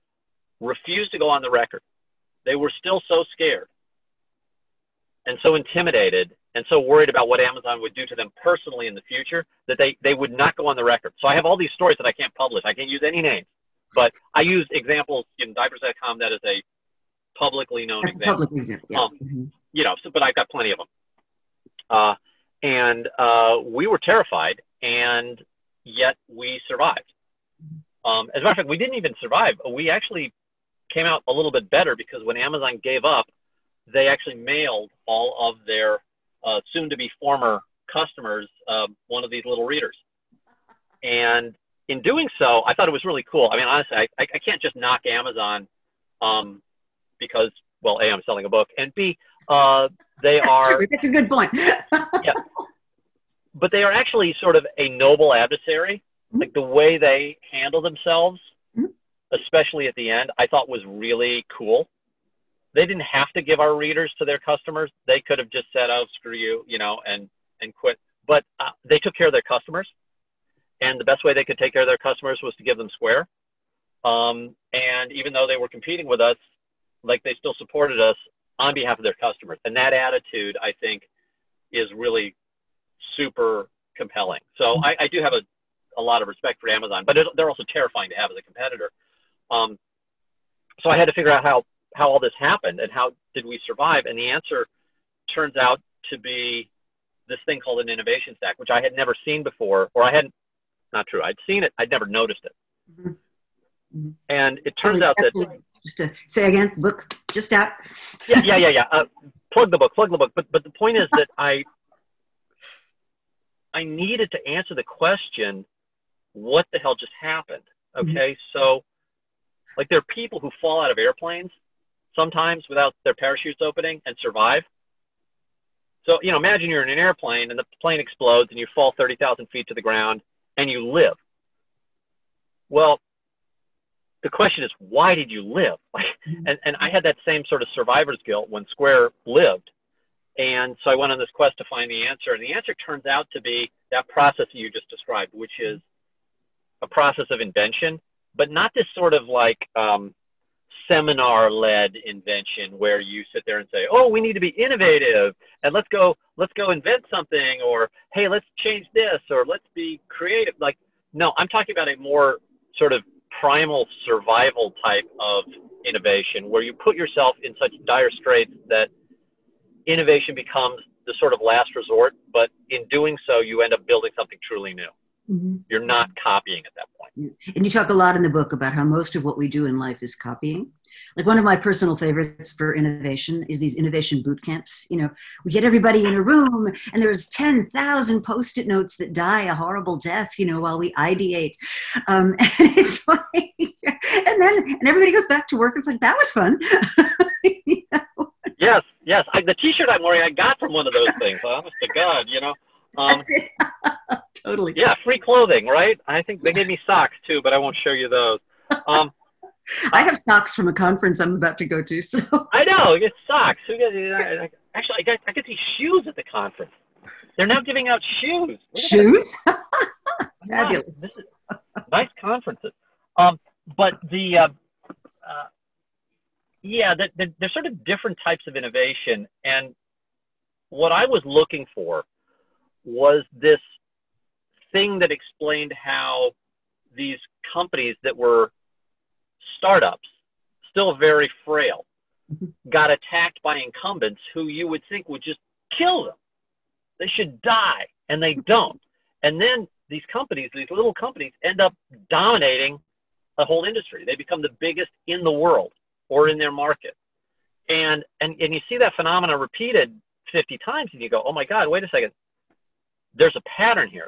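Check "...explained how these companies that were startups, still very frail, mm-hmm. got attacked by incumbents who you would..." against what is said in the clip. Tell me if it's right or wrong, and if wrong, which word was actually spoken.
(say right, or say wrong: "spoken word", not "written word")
right.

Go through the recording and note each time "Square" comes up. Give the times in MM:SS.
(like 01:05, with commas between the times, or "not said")
01:12, 02:18.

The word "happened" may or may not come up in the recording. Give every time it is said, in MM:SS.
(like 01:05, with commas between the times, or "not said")
01:32, 01:57.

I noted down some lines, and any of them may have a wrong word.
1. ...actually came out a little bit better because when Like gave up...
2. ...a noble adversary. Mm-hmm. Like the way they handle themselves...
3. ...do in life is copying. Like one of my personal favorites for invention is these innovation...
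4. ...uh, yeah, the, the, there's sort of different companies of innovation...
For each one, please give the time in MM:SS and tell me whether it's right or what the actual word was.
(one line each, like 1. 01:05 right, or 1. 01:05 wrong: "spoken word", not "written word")
1. 00:29 wrong: "Amazon", not "Like"
2. 00:54 right
3. 02:59 wrong: "innovation", not "invention"
4. 03:44 wrong: "types", not "companies".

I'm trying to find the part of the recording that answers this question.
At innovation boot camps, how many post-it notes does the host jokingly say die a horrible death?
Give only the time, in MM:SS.
03:07.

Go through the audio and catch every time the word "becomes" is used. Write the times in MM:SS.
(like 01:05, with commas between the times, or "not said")
02:50, 04:14.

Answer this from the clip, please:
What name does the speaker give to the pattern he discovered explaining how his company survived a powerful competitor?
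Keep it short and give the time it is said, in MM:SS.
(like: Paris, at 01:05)
innovation stack, at 01:37.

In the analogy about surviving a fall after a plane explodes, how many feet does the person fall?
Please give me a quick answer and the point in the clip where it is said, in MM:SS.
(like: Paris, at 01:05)
30,000, at 02:08.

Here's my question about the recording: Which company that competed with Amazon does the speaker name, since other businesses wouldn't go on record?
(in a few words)
diapers.com.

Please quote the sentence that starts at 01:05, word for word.
They could have just said, "Oh, screw you," you know, and and quit.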